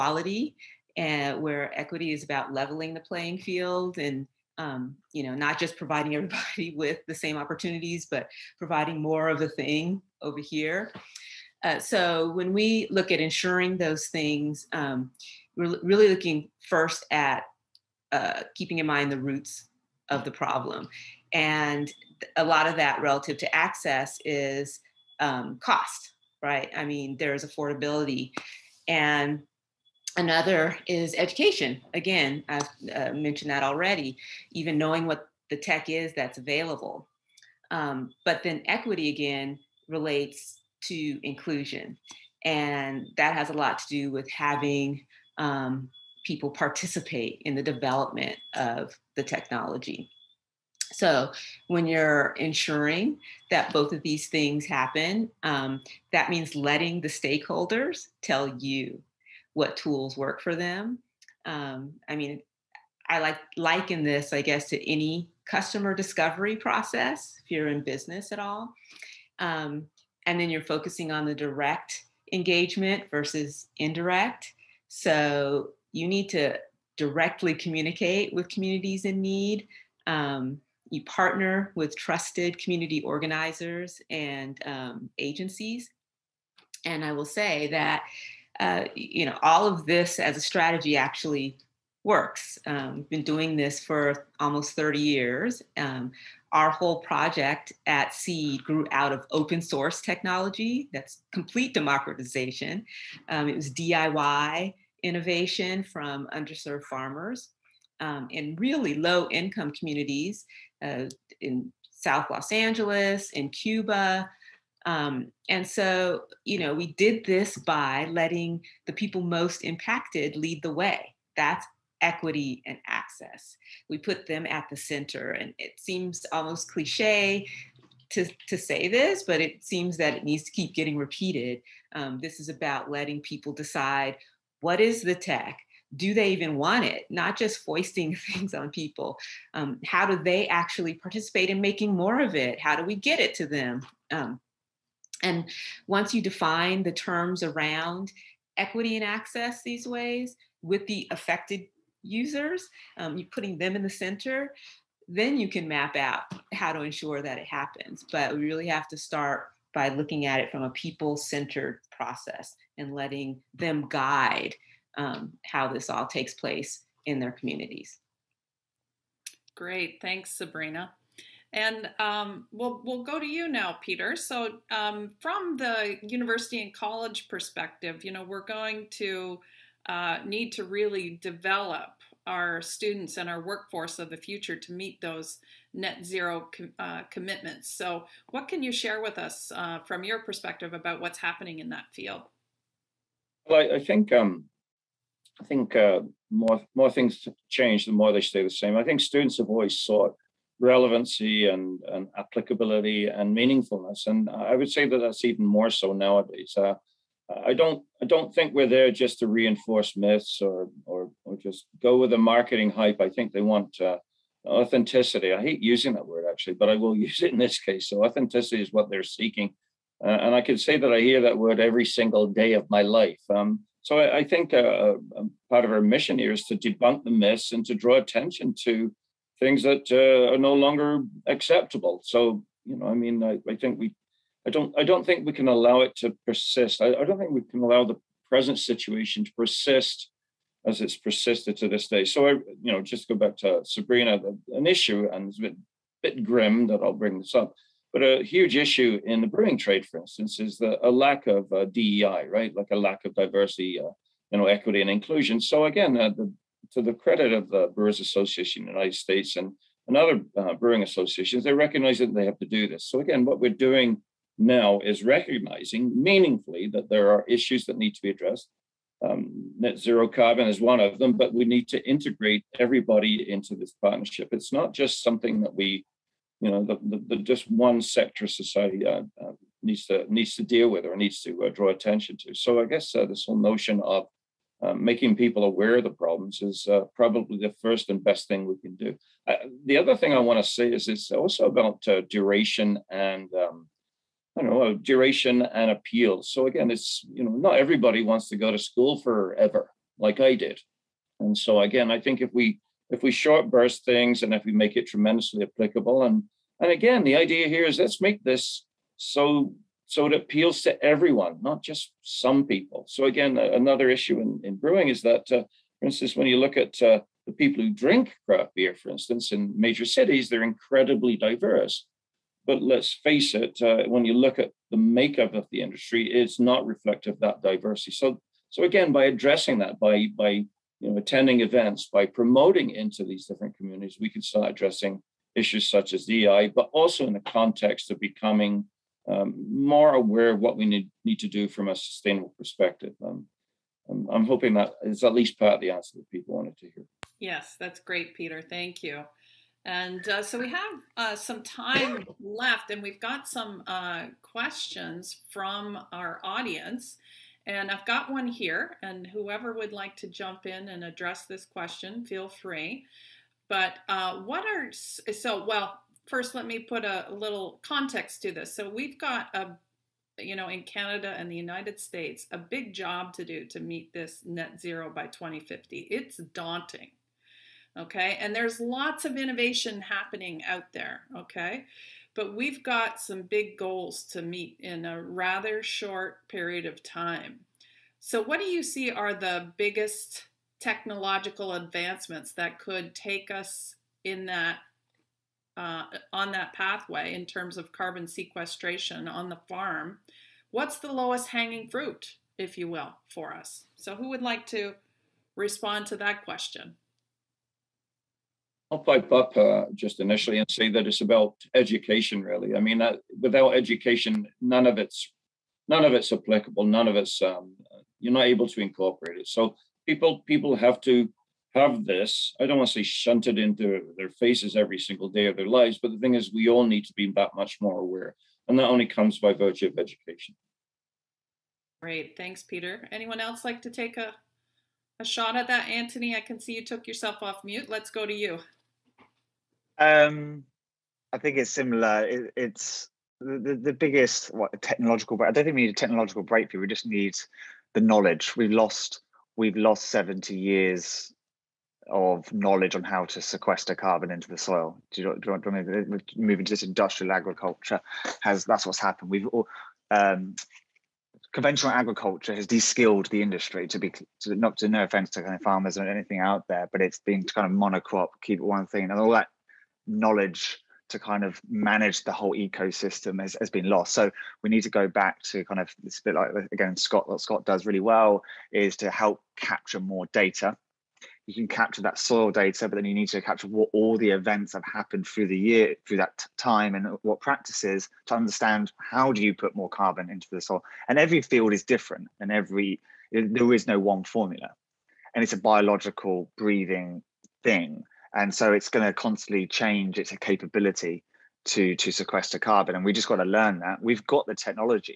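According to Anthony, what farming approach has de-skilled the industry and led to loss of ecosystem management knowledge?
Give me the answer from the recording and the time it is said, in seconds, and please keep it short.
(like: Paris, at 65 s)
Conventional agriculture, at 461 s.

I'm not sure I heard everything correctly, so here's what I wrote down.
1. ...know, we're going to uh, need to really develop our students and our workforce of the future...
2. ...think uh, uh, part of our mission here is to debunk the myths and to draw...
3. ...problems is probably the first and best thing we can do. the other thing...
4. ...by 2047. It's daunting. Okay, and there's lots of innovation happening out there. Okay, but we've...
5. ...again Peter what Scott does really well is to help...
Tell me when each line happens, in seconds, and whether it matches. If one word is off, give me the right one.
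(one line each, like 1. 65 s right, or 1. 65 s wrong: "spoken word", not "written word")
1. 178 s right
2. 224 s right
3. 285 s right
4. 374 s wrong: "2050", not "2047"
5. 476 s wrong: "Scott", not "Peter".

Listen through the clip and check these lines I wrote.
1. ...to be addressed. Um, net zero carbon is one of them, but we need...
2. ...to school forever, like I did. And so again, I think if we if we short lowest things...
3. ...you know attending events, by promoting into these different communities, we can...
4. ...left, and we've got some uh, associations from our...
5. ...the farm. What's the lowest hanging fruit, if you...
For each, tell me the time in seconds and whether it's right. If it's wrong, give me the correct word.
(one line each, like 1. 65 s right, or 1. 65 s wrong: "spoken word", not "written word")
1. 267 s right
2. 298 s wrong: "burst", not "lowest"
3. 330 s right
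4. 352 s wrong: "questions", not "associations"
5. 399 s right.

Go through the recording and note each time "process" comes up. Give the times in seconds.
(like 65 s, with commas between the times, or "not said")
66 s, 161 s.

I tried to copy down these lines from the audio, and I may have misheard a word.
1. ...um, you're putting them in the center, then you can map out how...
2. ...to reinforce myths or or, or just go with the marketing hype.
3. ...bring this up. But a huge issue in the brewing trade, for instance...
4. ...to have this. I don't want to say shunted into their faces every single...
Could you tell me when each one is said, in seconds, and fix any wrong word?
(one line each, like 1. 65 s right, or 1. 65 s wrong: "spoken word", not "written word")
1. 152 s right
2. 209 s right
3. 247 s right
4. 420 s right.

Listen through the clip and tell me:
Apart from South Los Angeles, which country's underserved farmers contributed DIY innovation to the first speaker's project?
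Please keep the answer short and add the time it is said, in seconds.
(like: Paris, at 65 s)
Cuba, at 113 s.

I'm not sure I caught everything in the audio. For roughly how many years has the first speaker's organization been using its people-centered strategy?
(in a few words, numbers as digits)
Almost 30 years.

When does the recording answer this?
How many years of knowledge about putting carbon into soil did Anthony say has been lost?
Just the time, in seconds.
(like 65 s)
449 s.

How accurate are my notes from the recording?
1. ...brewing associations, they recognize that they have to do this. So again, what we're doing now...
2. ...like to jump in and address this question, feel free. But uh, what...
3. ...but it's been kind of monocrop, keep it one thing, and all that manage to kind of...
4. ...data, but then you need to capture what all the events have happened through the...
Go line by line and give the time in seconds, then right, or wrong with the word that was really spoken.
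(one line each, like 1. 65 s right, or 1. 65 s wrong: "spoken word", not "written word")
1. 260 s right
2. 359 s right
3. 466 s wrong: "knowledge", not "manage"
4. 482 s right.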